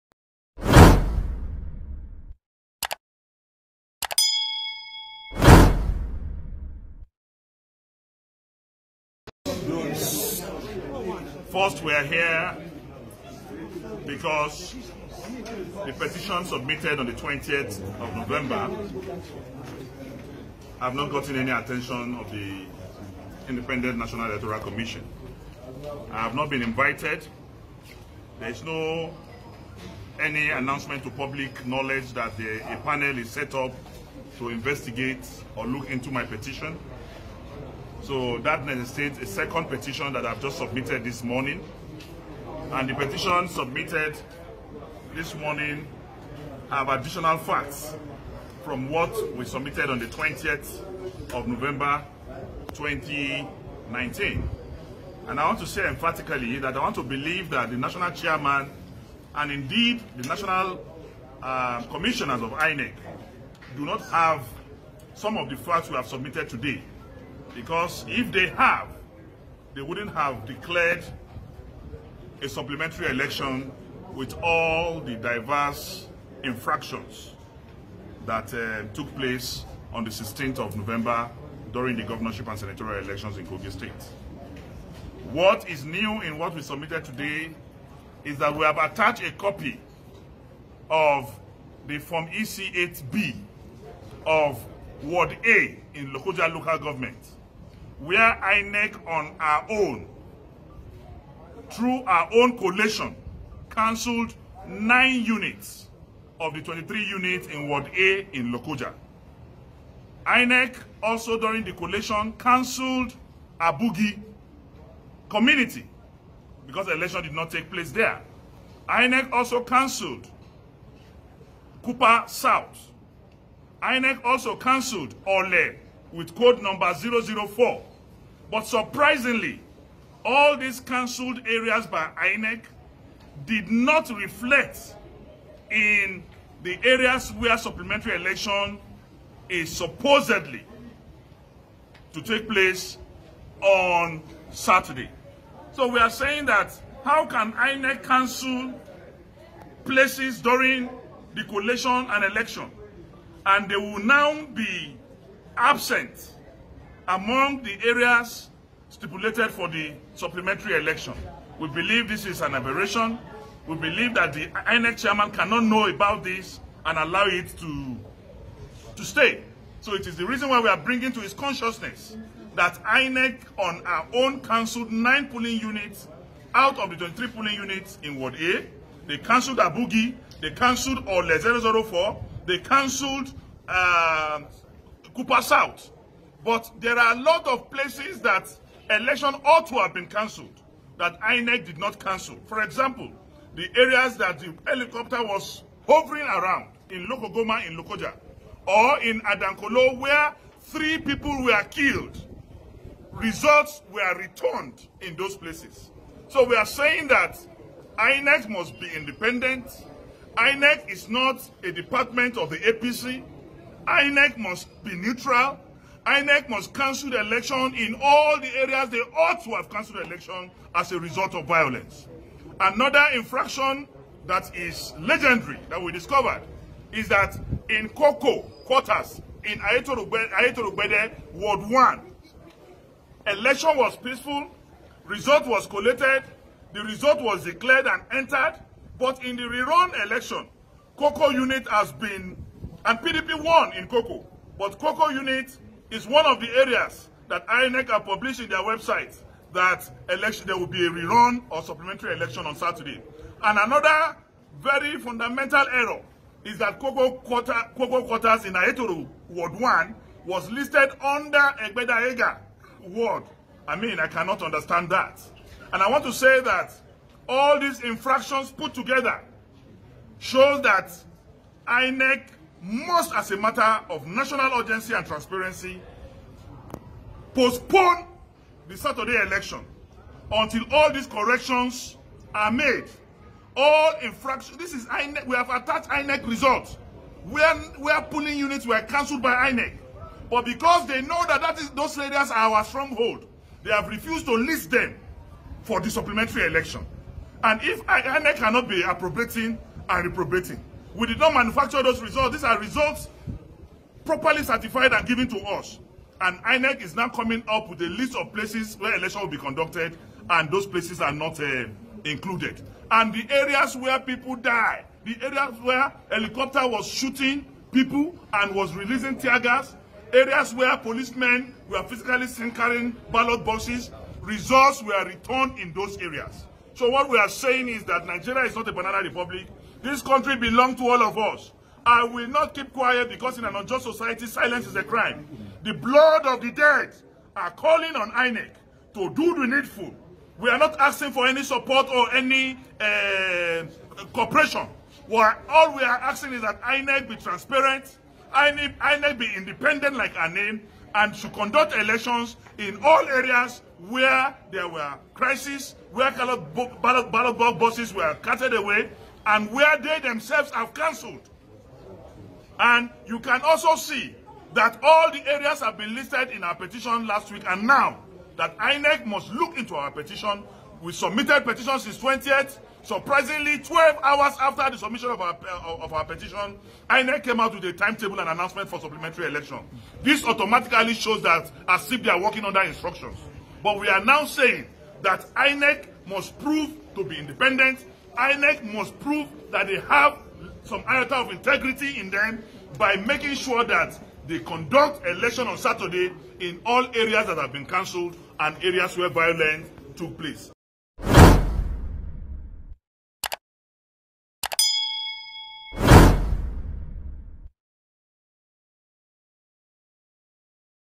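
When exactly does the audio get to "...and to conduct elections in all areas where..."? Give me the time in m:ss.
5:50.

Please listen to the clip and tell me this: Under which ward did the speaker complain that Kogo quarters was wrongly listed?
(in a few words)
Egbeda Ega Ward.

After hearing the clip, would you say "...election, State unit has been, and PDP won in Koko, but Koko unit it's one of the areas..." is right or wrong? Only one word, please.
wrong.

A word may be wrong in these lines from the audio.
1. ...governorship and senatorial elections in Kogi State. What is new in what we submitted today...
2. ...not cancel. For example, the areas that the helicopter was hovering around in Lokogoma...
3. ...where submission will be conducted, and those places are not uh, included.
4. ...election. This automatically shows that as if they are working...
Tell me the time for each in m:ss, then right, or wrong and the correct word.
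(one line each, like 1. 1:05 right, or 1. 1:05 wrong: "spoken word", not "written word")
1. 1:22 right
2. 3:11 right
3. 5:08 wrong: "election", not "submission"
4. 6:19 right.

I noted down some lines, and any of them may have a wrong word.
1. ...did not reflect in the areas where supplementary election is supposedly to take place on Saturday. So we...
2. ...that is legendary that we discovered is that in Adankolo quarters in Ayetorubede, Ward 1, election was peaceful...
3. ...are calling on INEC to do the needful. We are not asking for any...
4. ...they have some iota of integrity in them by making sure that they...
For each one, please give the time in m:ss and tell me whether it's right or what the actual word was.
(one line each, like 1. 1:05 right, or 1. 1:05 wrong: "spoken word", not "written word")
1. 2:13 right
2. 3:44 wrong: "Koko", not "Adankolo"
3. 5:37 right
4. 6:29 right.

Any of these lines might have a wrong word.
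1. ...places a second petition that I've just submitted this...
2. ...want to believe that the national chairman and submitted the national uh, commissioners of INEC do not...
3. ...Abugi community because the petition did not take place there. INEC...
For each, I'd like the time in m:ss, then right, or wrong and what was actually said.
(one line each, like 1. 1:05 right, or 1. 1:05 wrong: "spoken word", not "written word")
1. 0:38 wrong: "necessitates", not "places"
2. 0:56 wrong: "indeed", not "submitted"
3. 1:53 wrong: "election", not "petition".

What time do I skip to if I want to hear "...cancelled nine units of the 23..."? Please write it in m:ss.
1:43.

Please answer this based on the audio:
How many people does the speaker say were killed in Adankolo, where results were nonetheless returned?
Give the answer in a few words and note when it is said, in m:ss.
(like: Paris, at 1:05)
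3, at 3:20.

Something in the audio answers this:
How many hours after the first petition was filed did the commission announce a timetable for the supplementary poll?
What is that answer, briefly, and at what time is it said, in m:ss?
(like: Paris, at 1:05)
12, at 6:13.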